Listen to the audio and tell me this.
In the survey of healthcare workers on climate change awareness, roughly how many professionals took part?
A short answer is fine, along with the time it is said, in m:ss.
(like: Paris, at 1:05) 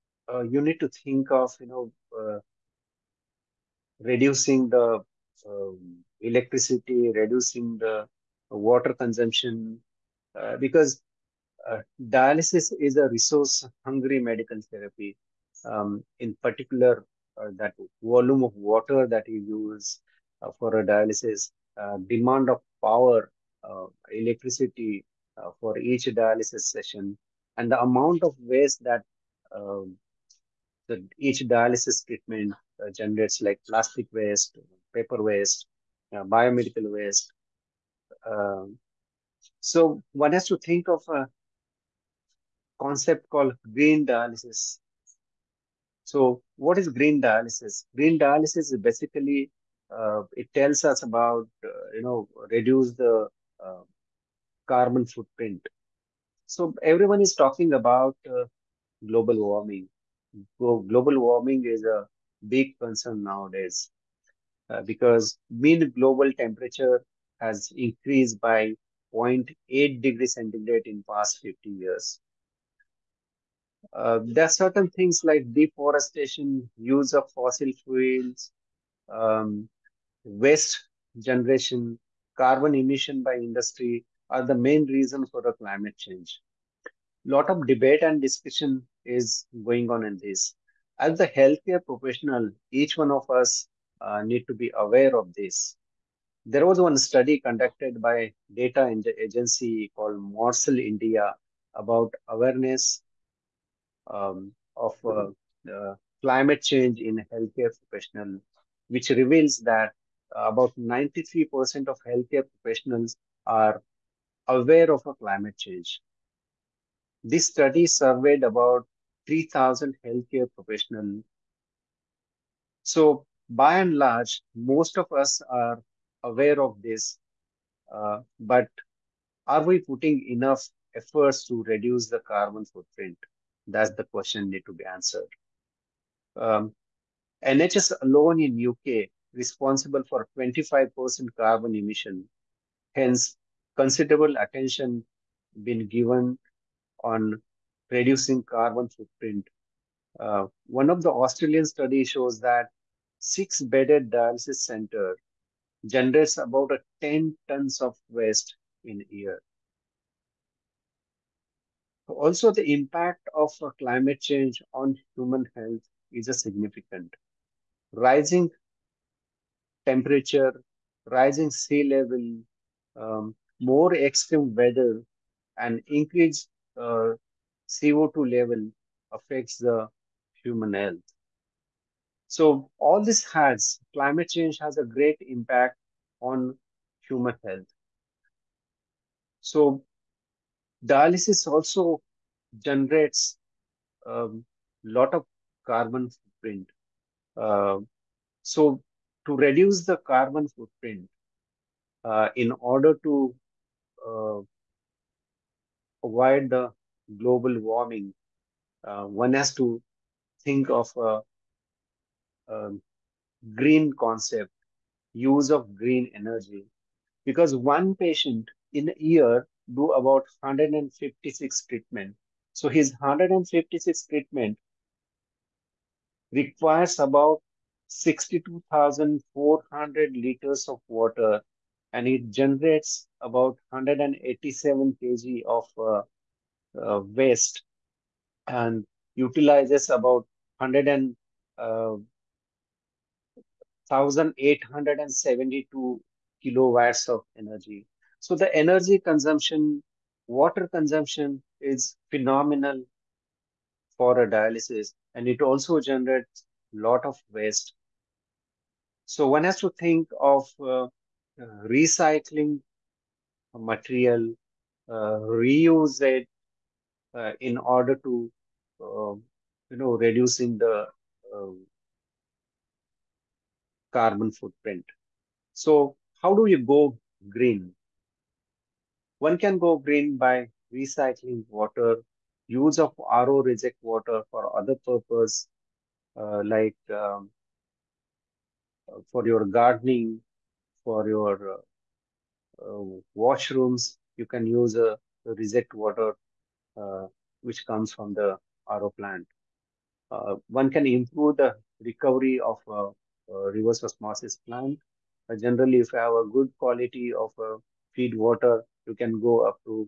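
3,000, at 1:59.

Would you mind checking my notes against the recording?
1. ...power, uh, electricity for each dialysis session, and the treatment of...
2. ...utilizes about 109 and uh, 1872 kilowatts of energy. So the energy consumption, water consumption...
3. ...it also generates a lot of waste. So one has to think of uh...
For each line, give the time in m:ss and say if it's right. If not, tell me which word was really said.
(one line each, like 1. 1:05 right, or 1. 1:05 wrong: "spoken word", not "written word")
1. 0:22 wrong: "amount", not "treatment"
2. 3:59 wrong: "100", not "109"
3. 4:15 right.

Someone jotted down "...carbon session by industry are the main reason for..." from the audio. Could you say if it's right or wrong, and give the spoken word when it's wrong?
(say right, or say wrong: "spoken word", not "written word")
wrong: "emission", not "session".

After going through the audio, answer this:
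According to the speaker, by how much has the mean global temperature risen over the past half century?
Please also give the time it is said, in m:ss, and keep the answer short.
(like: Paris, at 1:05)
0.8 degree centigrade, at 1:09.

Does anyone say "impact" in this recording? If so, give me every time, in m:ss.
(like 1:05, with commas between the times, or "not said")
2:42, 3:05.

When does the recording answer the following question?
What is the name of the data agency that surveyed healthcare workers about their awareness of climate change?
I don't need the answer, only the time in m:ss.
1:40.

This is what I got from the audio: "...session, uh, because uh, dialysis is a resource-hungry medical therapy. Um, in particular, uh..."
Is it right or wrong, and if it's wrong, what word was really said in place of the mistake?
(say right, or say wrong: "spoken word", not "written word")
wrong: "consumption", not "session".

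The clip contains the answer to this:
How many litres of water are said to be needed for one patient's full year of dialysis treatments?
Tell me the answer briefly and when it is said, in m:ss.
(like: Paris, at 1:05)
62,400 liters, at 3:47.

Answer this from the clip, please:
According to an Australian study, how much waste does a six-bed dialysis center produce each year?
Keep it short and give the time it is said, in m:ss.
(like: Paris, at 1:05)
10 tons, at 2:37.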